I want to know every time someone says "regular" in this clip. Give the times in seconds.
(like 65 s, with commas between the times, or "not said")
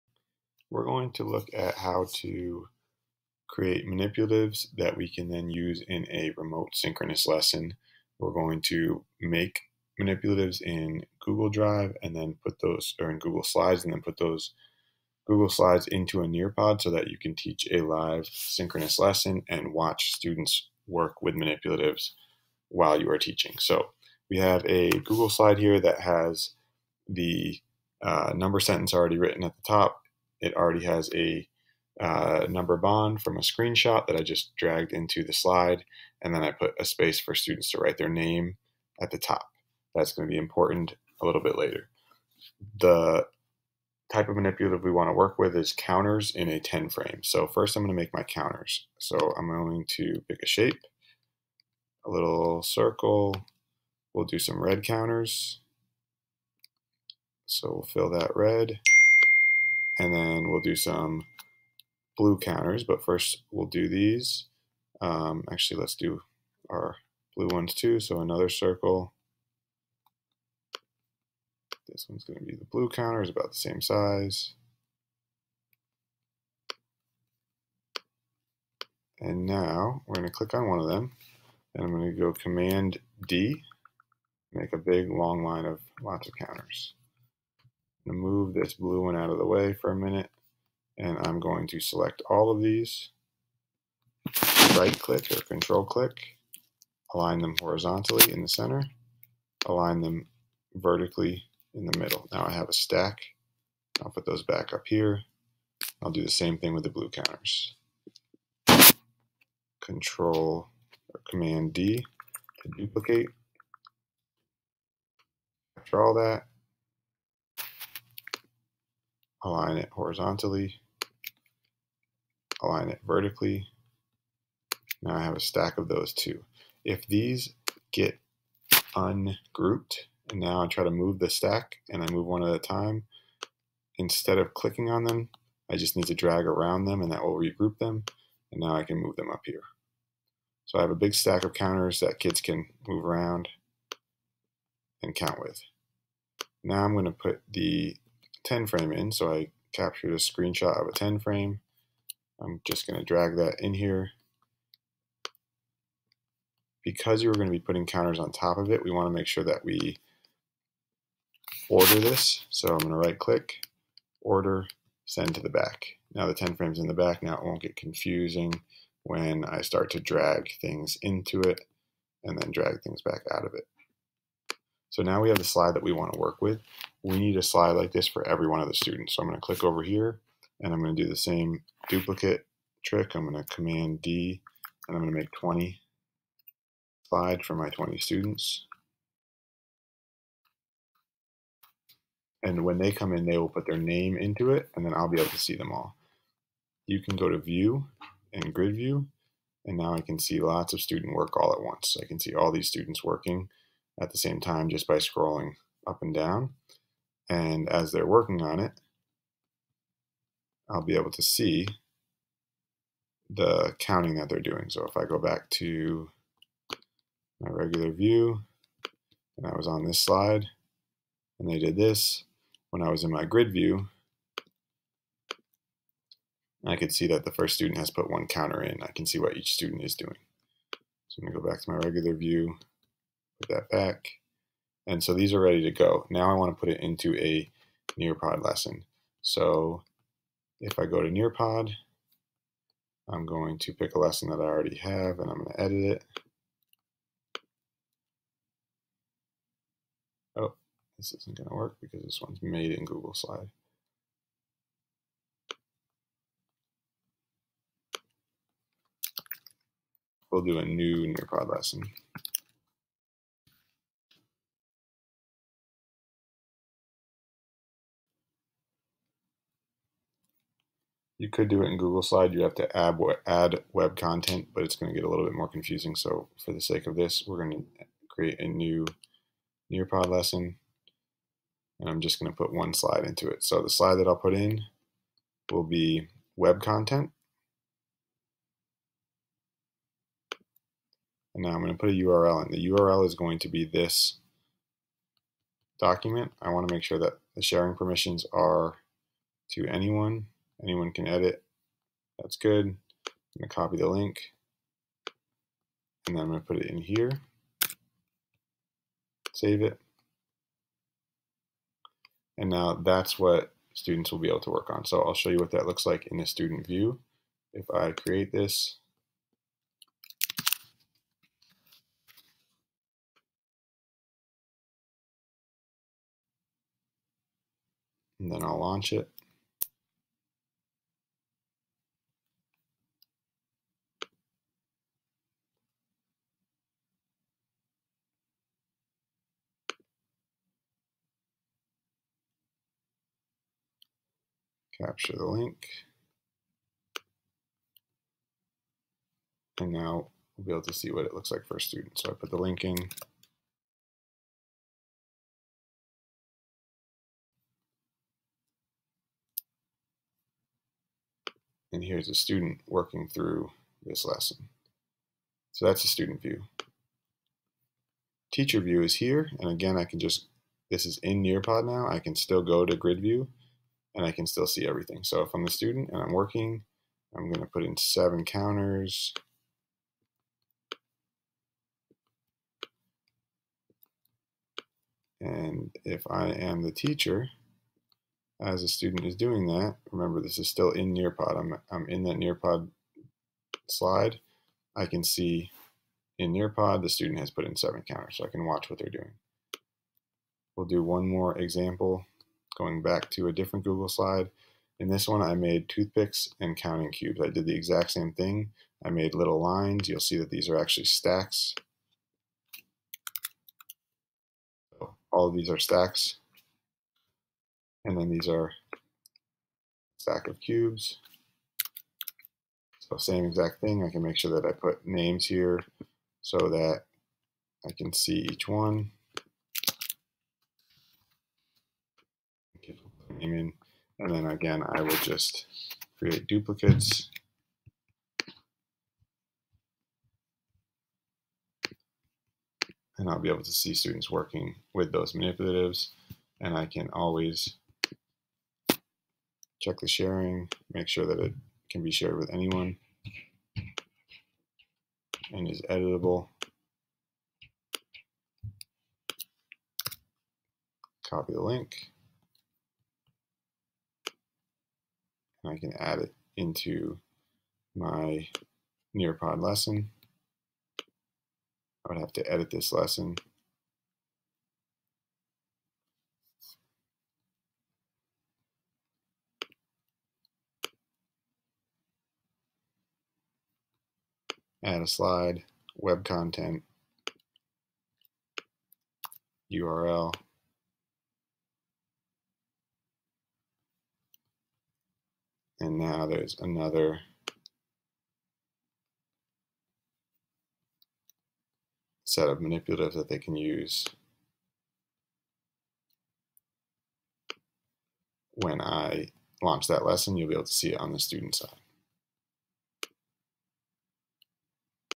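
217 s, 231 s.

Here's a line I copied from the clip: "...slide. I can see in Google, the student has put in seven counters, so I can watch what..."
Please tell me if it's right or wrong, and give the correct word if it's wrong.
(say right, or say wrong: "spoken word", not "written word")
wrong: "Nearpod", not "Google".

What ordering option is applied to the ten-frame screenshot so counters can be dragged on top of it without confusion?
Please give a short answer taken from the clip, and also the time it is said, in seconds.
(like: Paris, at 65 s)
send to the back, at 165 s.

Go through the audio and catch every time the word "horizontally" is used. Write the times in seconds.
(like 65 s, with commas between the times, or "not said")
97 s, 119 s.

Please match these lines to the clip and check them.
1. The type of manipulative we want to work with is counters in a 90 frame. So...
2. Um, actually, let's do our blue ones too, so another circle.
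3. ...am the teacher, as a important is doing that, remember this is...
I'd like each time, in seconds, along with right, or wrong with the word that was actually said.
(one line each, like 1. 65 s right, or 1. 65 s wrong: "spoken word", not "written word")
1. 42 s wrong: "10", not "90"
2. 64 s right
3. 386 s wrong: "student", not "important".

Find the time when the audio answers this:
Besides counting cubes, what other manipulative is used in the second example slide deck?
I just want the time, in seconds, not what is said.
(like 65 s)
405 s.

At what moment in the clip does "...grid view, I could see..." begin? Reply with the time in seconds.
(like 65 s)
223 s.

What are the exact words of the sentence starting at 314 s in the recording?
So I'll show you what that looks like in the student view.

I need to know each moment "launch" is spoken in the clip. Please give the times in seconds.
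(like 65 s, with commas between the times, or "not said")
328 s, 509 s.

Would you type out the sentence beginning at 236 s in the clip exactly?
Now I want to put it into a Nearpod lesson.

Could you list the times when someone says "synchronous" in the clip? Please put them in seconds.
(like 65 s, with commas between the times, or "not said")
6 s, 18 s.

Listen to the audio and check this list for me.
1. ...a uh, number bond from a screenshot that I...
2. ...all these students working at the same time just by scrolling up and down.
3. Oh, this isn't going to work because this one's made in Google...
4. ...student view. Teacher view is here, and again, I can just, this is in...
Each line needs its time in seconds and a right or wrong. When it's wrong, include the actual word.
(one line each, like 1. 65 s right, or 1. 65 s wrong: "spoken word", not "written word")
1. 31 s right
2. 202 s right
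3. 250 s right
4. 365 s right.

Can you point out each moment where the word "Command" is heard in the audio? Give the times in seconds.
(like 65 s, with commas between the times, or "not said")
82 s, 111 s, 183 s.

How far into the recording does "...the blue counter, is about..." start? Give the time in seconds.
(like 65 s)
72 s.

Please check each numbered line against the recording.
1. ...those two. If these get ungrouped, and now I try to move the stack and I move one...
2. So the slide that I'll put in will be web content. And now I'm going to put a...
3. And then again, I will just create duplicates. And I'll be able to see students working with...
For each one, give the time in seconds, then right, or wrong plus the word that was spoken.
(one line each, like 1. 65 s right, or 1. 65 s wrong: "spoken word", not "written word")
1. 125 s right
2. 283 s right
3. 433 s right.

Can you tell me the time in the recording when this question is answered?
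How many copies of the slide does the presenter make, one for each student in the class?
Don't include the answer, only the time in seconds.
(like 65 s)
185 s.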